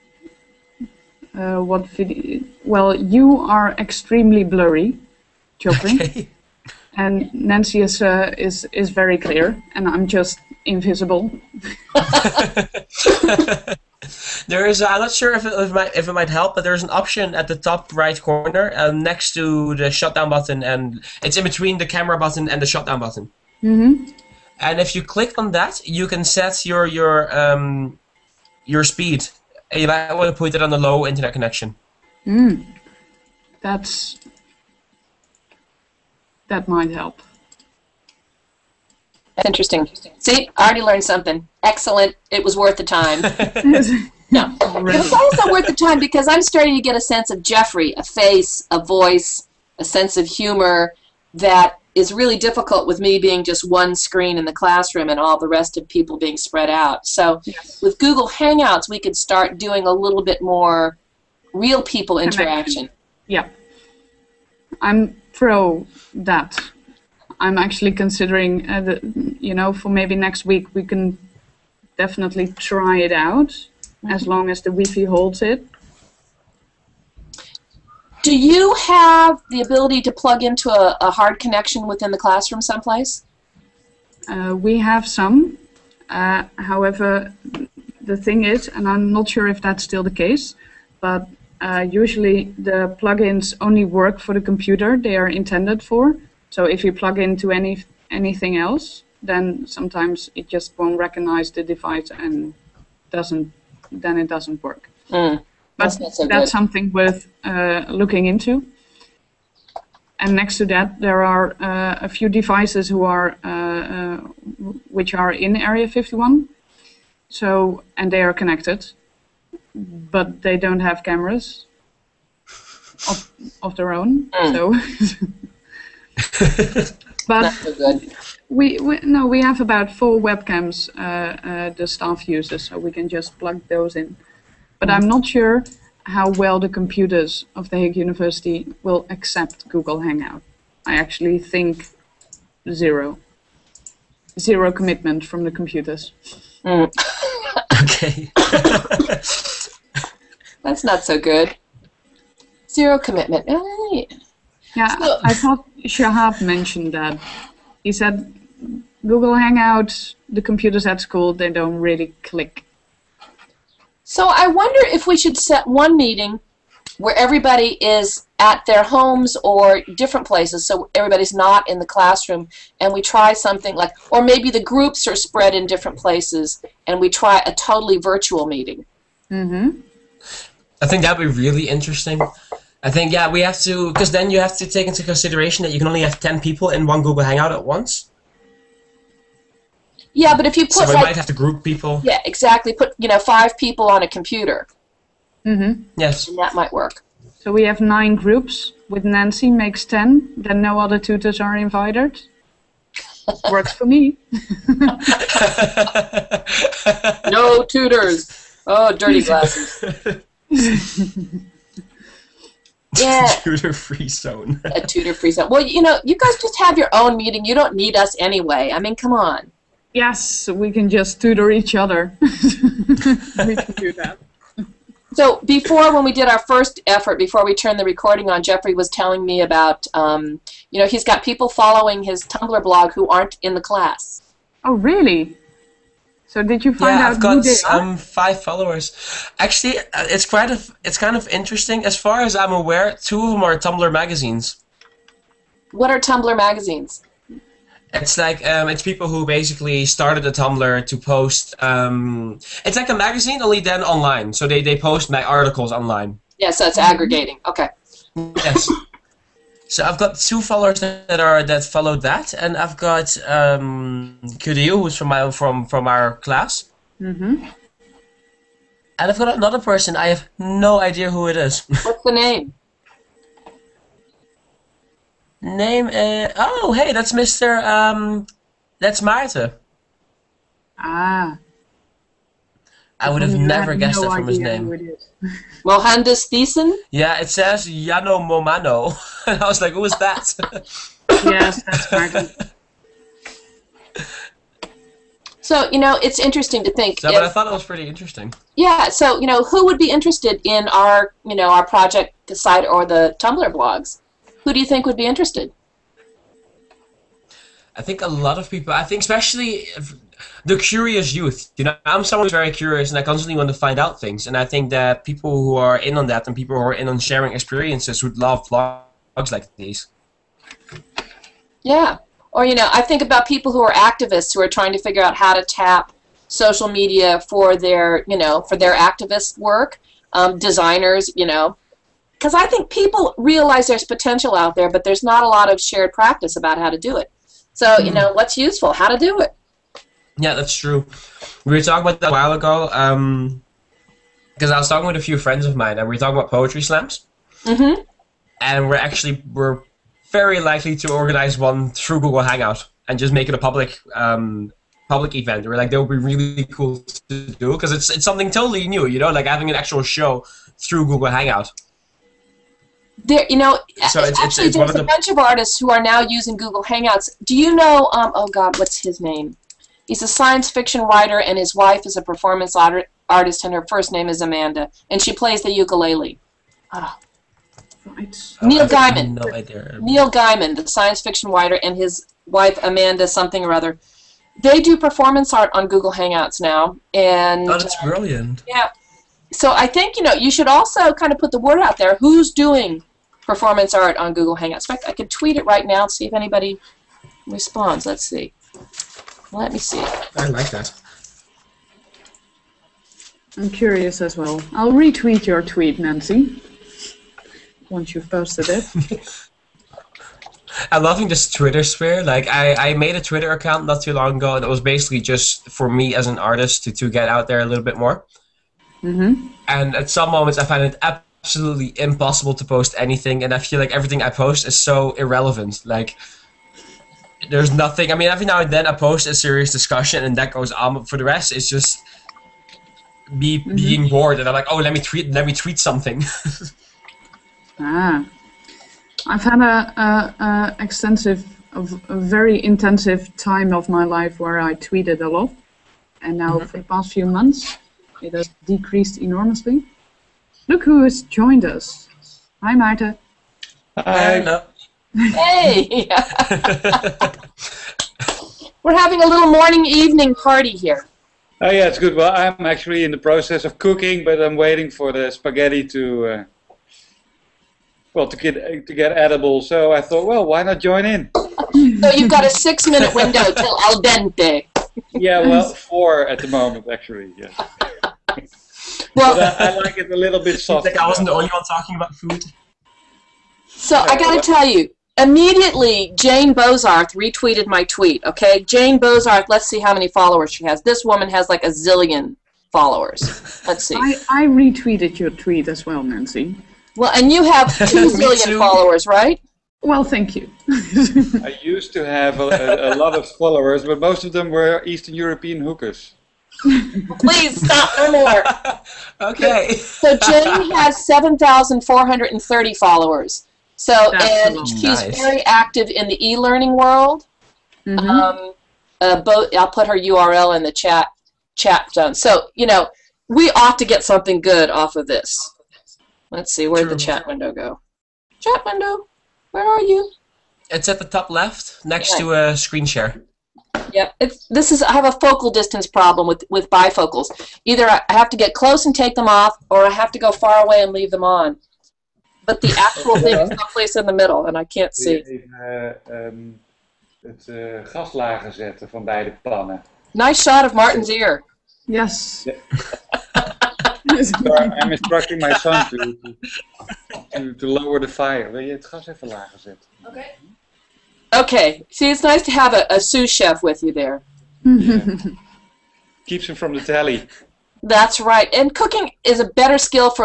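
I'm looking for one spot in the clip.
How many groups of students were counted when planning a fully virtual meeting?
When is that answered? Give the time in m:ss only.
3:17.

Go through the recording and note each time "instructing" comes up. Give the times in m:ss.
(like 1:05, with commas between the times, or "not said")
9:14.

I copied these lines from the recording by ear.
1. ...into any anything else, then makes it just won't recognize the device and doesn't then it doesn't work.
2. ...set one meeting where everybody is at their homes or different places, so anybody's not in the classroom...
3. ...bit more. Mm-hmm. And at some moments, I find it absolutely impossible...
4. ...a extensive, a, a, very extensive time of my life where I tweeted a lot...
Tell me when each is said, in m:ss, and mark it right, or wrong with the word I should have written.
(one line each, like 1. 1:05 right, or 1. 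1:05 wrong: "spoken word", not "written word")
1. 1:37 wrong: "sometimes", not "makes"
2. 2:45 wrong: "everybody", not "anybody"
3. 6:57 right
4. 7:20 wrong: "intensive", not "extensive".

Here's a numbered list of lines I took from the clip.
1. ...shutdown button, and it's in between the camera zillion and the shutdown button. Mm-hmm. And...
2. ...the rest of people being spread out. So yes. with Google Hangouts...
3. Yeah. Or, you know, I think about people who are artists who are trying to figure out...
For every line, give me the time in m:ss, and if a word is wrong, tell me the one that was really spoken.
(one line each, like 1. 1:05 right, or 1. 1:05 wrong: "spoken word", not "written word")
1. 0:19 wrong: "button", not "zillion"
2. 0:55 right
3. 5:21 wrong: "activists", not "artists".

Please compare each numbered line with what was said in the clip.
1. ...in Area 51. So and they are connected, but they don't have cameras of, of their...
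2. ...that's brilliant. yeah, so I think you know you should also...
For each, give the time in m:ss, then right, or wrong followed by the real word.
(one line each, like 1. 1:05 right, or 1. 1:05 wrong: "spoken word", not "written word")
1. 1:55 right
2. 6:27 right.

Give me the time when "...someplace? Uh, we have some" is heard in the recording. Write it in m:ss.
1:22.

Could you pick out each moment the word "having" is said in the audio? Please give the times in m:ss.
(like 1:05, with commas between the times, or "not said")
5:59, 7:38.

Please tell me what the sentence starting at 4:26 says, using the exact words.
hmm And I've got another person.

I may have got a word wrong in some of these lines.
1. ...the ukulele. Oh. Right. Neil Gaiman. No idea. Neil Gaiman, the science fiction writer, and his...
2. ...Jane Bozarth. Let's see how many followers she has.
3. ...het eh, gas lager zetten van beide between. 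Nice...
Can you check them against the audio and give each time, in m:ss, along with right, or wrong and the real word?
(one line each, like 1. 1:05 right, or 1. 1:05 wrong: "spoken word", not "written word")
1. 6:15 right
2. 8:08 right
3. 9:07 wrong: "pannen", not "between".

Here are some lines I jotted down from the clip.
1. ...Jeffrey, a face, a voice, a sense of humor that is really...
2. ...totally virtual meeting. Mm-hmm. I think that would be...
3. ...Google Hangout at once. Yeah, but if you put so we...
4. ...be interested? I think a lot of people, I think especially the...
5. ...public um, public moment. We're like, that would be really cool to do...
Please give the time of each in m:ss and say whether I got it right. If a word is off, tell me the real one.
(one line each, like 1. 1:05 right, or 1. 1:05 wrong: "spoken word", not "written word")
1. 0:47 right
2. 2:57 right
3. 3:07 right
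4. 5:04 right
5. 5:53 wrong: "event", not "moment".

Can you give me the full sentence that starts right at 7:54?
yeah, well, four at the moment, actually.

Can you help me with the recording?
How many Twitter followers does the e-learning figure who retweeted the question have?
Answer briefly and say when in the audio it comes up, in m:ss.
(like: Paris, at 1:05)
7,430, at 8:30.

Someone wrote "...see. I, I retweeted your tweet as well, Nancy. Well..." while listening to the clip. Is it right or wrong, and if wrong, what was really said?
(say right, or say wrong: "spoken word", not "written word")
right.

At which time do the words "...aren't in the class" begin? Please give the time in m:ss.
3:53.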